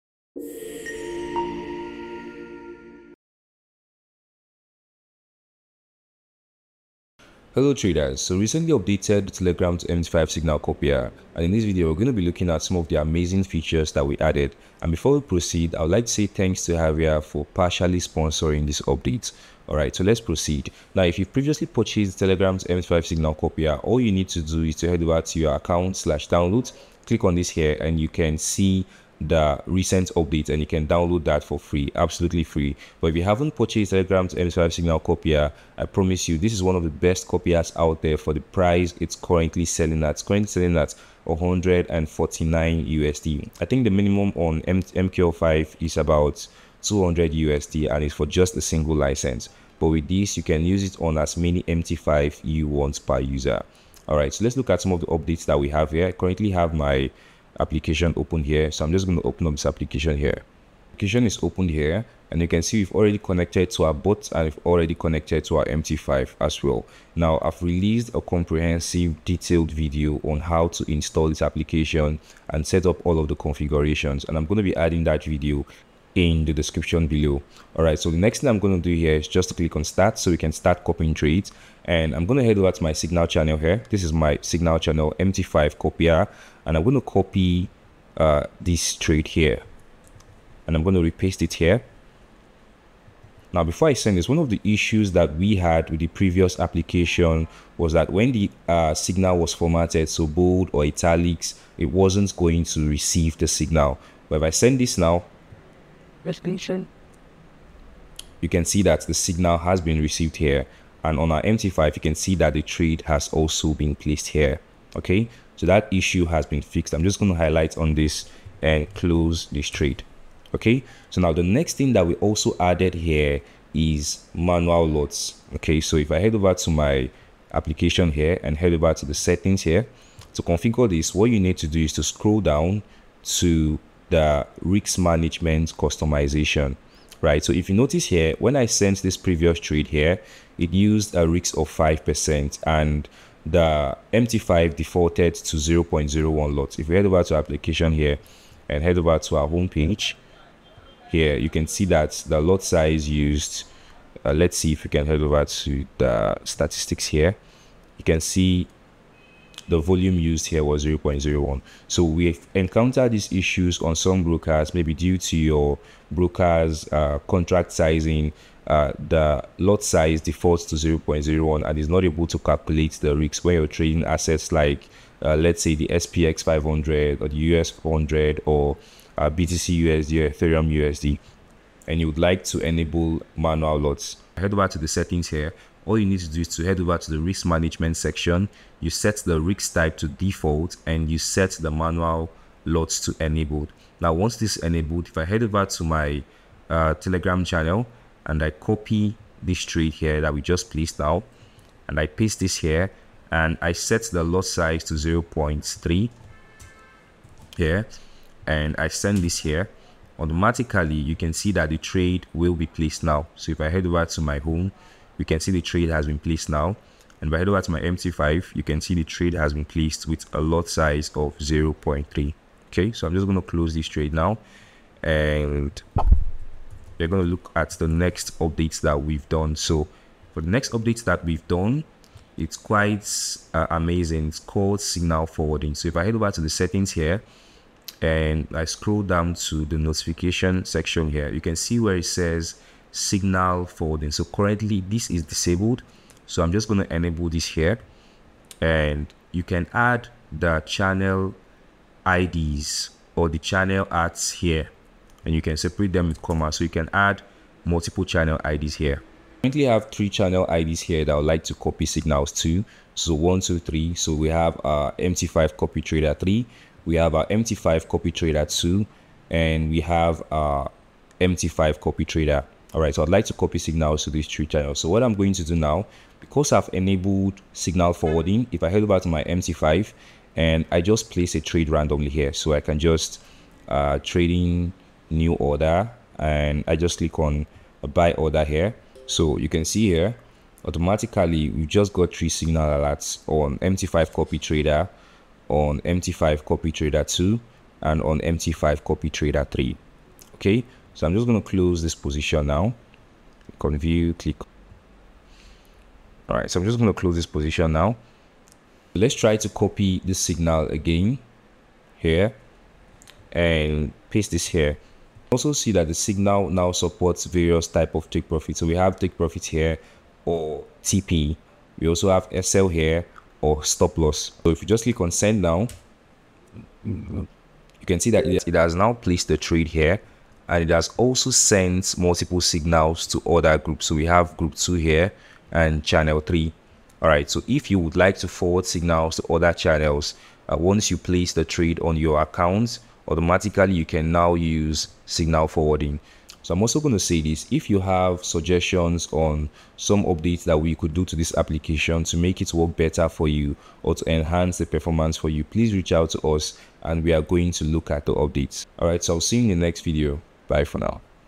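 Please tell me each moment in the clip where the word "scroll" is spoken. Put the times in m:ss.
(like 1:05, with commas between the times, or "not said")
2:12, 3:58.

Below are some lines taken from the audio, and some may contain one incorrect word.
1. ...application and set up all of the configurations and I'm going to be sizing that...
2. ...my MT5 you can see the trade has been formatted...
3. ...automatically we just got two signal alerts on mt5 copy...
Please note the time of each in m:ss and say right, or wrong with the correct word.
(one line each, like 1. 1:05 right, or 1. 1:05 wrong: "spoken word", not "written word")
1. 1:11 wrong: "adding", not "sizing"
2. 3:37 wrong: "placed", not "formatted"
3. 4:50 wrong: "three", not "two".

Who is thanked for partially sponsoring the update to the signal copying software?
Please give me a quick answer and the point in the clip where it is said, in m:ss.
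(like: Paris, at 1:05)
Javier, at 0:16.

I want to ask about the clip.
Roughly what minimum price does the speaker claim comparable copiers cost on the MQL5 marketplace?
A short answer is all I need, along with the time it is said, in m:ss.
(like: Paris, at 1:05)
200 USD, at 0:46.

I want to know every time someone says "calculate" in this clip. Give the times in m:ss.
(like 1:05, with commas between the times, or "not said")
2:52.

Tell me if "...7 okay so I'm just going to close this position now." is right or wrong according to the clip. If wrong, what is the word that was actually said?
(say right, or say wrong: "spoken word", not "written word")
wrong: "3", not "7".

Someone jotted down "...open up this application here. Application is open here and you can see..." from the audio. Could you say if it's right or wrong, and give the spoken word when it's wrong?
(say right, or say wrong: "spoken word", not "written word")
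right.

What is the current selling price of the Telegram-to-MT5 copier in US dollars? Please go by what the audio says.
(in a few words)
149 USD.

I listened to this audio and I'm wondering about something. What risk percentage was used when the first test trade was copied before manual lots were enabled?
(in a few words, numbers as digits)
5%.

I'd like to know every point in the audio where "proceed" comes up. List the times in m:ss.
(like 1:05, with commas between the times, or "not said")
0:15, 0:20.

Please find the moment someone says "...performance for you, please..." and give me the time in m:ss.
5:54.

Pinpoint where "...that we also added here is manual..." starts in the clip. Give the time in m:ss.
2:01.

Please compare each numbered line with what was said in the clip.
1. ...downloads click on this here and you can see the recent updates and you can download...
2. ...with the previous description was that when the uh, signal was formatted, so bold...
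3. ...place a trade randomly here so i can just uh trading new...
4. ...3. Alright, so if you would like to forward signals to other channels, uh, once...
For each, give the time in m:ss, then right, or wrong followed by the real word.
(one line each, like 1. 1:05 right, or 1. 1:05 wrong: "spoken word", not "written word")
1. 0:26 right
2. 1:35 wrong: "application", not "description"
3. 4:41 right
4. 5:36 right.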